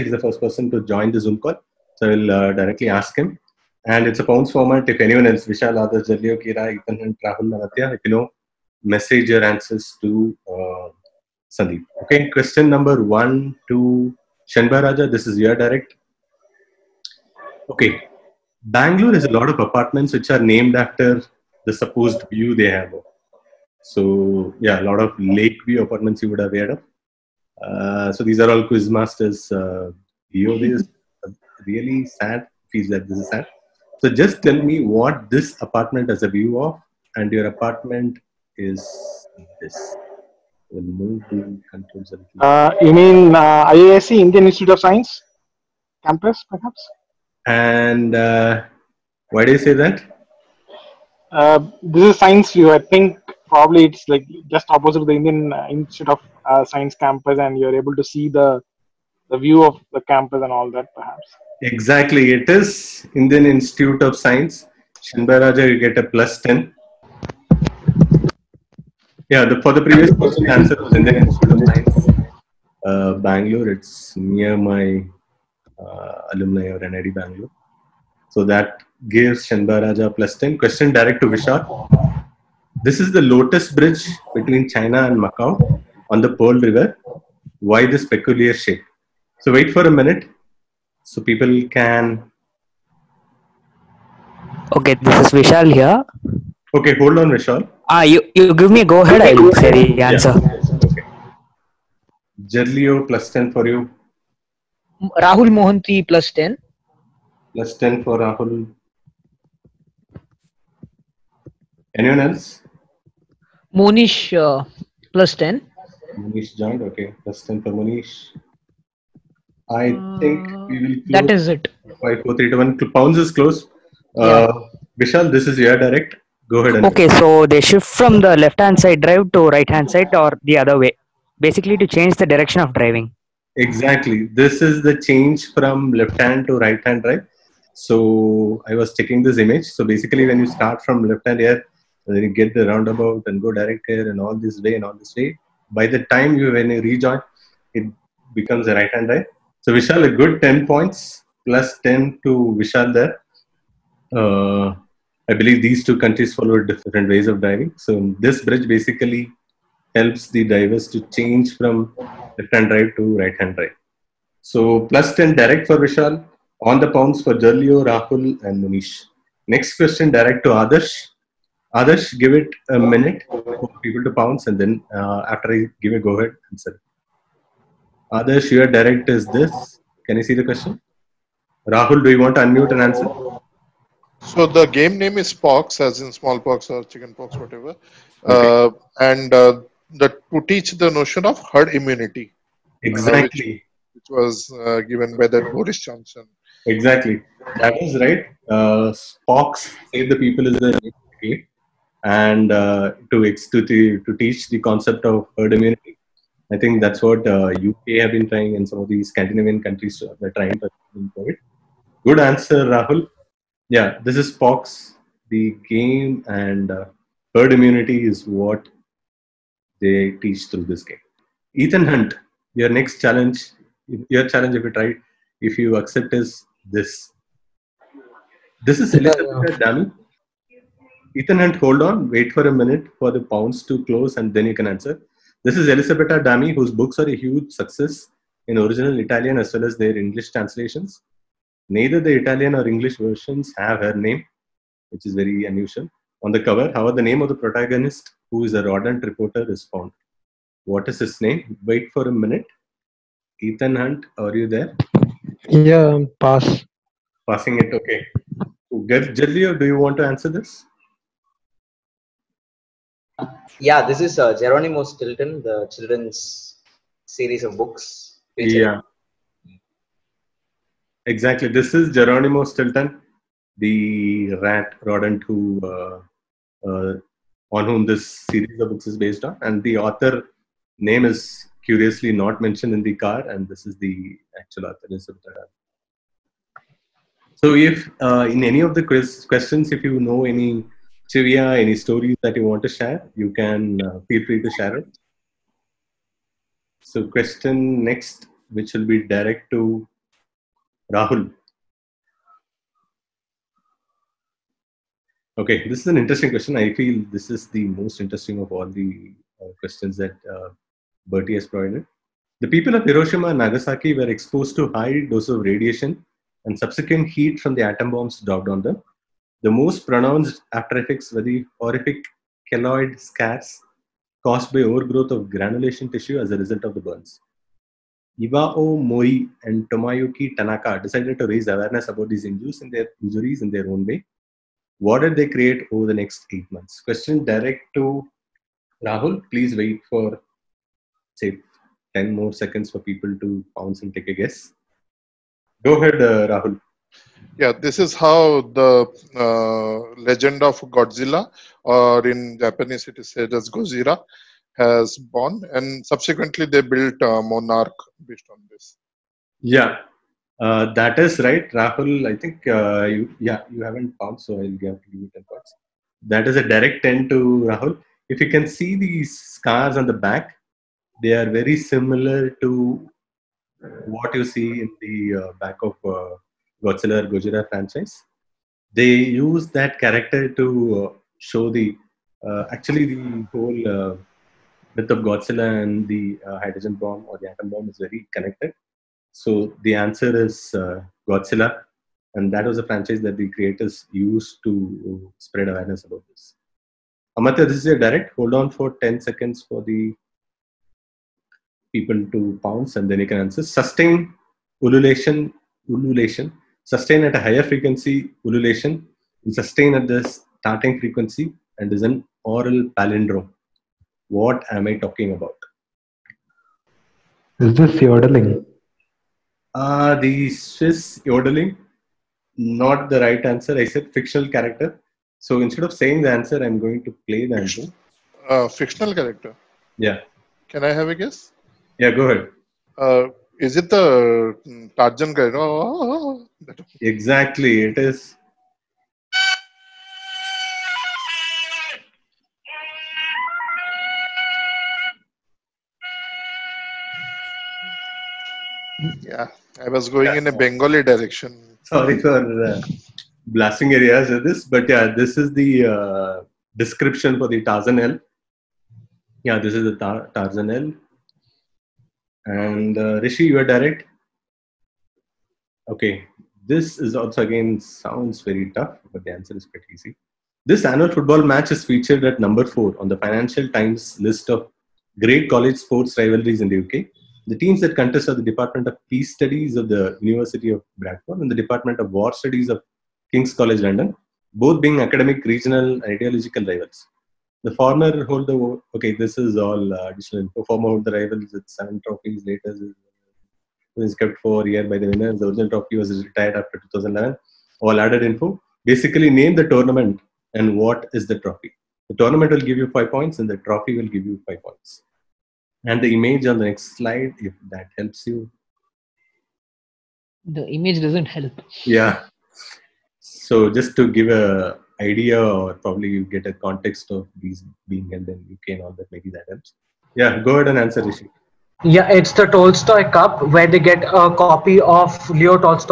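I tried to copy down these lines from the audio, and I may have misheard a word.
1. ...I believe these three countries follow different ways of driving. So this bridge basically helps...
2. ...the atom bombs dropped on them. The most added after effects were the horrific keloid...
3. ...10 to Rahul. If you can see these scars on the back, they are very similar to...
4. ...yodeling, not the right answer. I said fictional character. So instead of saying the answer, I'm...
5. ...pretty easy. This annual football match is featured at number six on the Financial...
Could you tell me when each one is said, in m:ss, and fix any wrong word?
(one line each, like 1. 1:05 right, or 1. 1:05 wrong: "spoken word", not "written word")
1. 2:35 wrong: "two", not "three"
2. 5:17 wrong: "pronounced", not "added"
3. 6:06 right
4. 7:01 right
5. 7:49 wrong: "four", not "six".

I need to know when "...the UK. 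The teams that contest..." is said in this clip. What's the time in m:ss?
7:56.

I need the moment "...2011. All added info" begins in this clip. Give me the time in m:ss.
8:16.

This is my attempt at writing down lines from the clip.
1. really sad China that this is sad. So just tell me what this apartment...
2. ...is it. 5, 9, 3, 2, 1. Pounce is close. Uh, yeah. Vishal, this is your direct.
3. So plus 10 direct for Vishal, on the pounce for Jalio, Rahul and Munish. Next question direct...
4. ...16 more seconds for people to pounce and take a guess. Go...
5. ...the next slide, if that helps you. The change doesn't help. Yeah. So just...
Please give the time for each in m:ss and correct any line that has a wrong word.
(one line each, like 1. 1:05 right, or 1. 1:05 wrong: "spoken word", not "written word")
1. 0:31 wrong: "Feels", not "China"
2. 2:01 wrong: "4", not "9"
3. 2:44 right
4. 5:41 wrong: "10", not "16"
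5. 8:26 wrong: "image", not "change".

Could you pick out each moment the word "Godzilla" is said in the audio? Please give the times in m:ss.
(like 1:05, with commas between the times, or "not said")
5:50, 6:16, 6:24, 6:31.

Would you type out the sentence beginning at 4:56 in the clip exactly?
So question next, which will be direct to Rahul.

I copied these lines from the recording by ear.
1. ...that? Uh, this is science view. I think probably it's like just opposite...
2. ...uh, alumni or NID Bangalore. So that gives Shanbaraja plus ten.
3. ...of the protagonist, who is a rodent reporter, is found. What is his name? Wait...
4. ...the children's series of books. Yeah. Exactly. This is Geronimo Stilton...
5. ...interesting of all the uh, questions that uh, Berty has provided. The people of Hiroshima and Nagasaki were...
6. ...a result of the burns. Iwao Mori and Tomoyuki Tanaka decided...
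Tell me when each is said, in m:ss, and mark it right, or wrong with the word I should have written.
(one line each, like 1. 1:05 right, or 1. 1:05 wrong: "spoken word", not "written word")
1. 0:49 right
2. 1:15 right
3. 4:07 right
4. 4:25 right
5. 5:08 right
6. 5:26 right.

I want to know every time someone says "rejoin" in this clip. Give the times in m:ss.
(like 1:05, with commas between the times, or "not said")
2:26.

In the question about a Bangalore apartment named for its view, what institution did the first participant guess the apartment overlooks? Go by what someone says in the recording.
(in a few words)
IISc.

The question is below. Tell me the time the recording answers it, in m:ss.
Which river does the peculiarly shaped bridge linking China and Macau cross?
1:26.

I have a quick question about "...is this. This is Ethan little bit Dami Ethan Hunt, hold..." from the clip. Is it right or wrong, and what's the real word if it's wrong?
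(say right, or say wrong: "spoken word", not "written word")
wrong: "Elizabeth", not "Ethan".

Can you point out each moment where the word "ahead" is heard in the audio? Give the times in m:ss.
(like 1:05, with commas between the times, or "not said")
1:39, 2:06, 2:56, 5:45, 7:12, 8:40.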